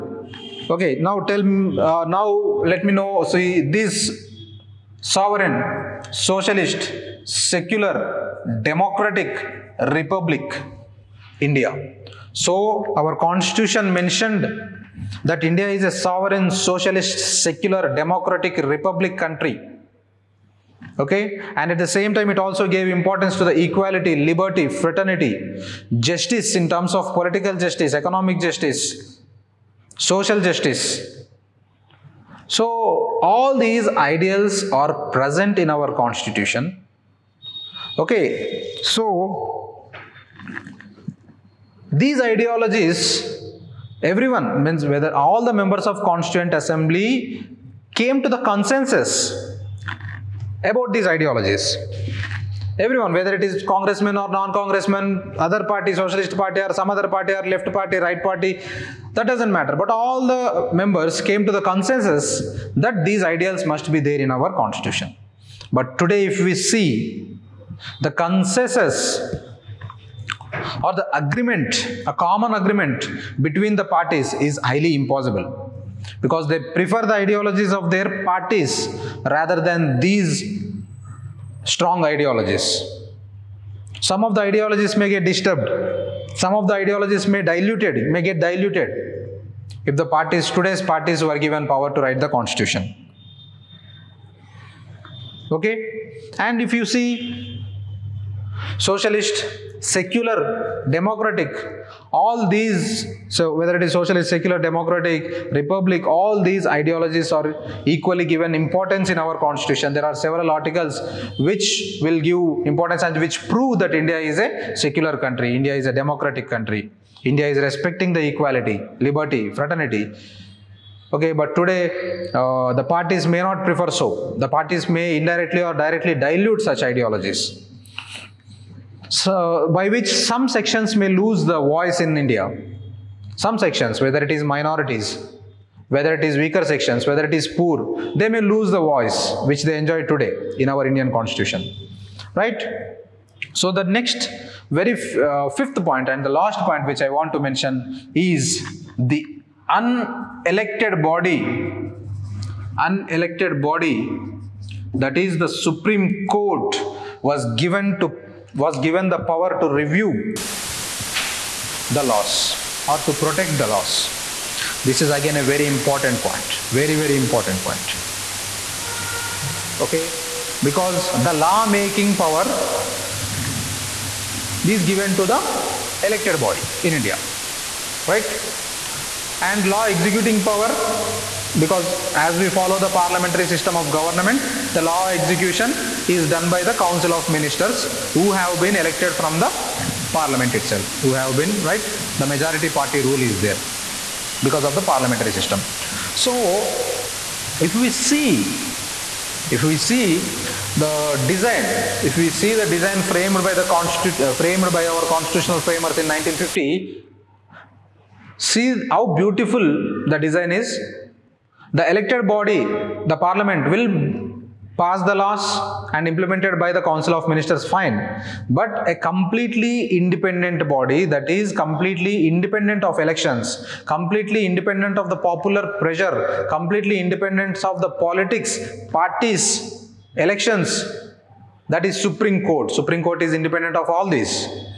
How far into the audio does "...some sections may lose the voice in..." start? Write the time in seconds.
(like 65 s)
130 s.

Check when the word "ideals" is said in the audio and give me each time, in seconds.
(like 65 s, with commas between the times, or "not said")
33 s, 63 s.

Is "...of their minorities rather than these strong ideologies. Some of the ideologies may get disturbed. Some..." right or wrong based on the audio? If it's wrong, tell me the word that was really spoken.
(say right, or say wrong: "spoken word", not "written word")
wrong: "parties", not "minorities".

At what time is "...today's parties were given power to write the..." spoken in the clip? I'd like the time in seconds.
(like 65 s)
90 s.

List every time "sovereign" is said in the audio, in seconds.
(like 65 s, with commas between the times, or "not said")
5 s, 16 s.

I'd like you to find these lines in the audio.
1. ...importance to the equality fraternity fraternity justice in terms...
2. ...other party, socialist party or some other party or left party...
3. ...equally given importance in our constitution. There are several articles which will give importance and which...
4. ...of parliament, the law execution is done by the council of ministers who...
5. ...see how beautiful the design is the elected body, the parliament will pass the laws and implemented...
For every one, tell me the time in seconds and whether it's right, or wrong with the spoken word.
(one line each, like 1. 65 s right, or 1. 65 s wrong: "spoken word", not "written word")
1. 22 s wrong: "liberty", not "fraternity"
2. 55 s right
3. 107 s right
4. 183 s wrong: "government", not "parliament"
5. 208 s right.